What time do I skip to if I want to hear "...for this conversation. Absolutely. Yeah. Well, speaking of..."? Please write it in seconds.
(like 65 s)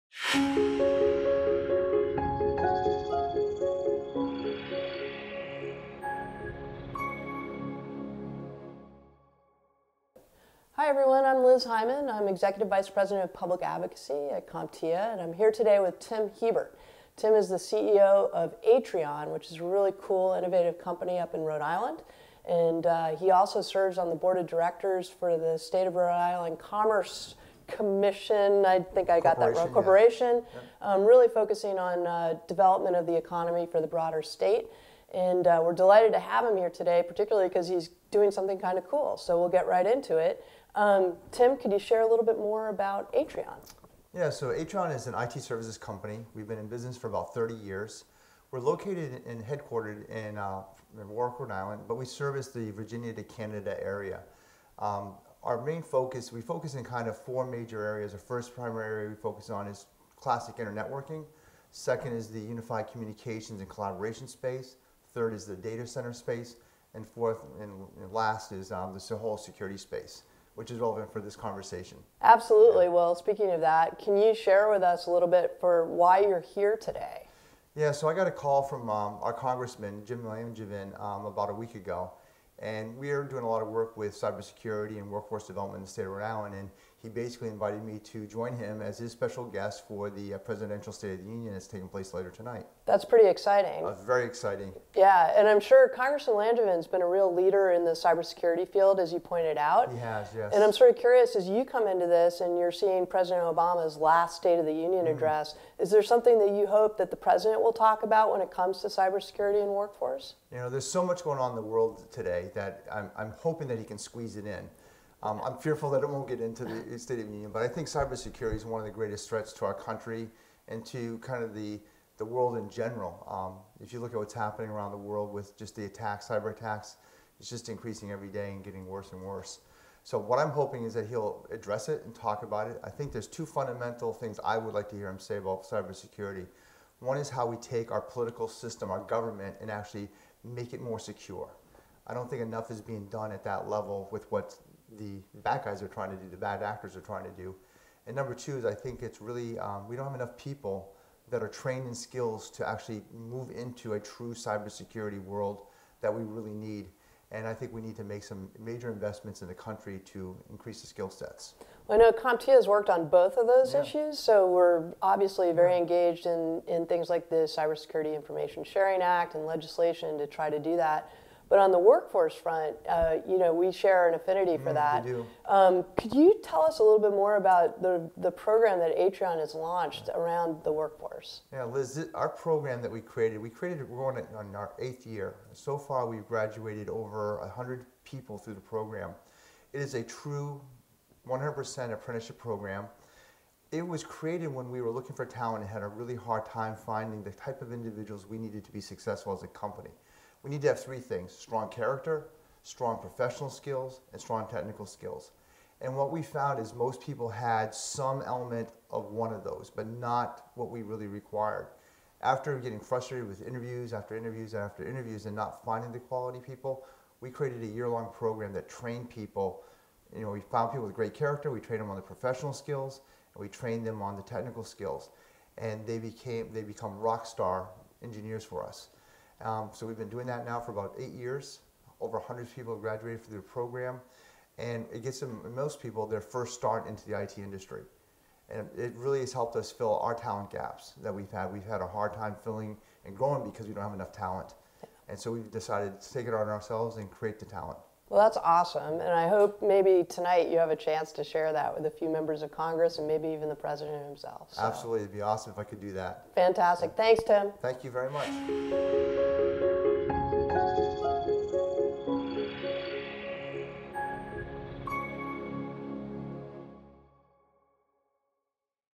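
71 s.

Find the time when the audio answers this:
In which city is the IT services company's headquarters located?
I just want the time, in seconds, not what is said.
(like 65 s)
51 s.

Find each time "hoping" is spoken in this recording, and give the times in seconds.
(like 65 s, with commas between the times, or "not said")
113 s, 130 s.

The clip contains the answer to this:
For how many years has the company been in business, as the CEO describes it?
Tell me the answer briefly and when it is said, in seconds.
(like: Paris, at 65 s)
30 years, at 47 s.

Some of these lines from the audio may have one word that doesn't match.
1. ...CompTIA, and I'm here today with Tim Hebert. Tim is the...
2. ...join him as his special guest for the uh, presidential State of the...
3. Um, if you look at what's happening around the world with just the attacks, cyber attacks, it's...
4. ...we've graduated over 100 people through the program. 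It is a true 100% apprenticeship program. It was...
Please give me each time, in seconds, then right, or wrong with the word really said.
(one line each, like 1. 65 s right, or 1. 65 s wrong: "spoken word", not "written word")
1. 14 s right
2. 88 s right
3. 123 s right
4. 186 s right.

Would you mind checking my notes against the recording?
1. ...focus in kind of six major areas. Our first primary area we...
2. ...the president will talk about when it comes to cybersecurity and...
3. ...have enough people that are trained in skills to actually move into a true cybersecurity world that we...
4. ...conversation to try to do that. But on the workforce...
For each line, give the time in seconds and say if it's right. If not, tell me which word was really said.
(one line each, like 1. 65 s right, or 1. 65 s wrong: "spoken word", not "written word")
1. 56 s wrong: "four", not "six"
2. 107 s right
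3. 150 s right
4. 169 s wrong: "legislation", not "conversation".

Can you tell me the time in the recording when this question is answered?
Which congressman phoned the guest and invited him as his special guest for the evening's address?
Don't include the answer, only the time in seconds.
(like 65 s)
80 s.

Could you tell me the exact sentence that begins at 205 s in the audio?
And what we found is most people had some element of one of those, but not what we really required.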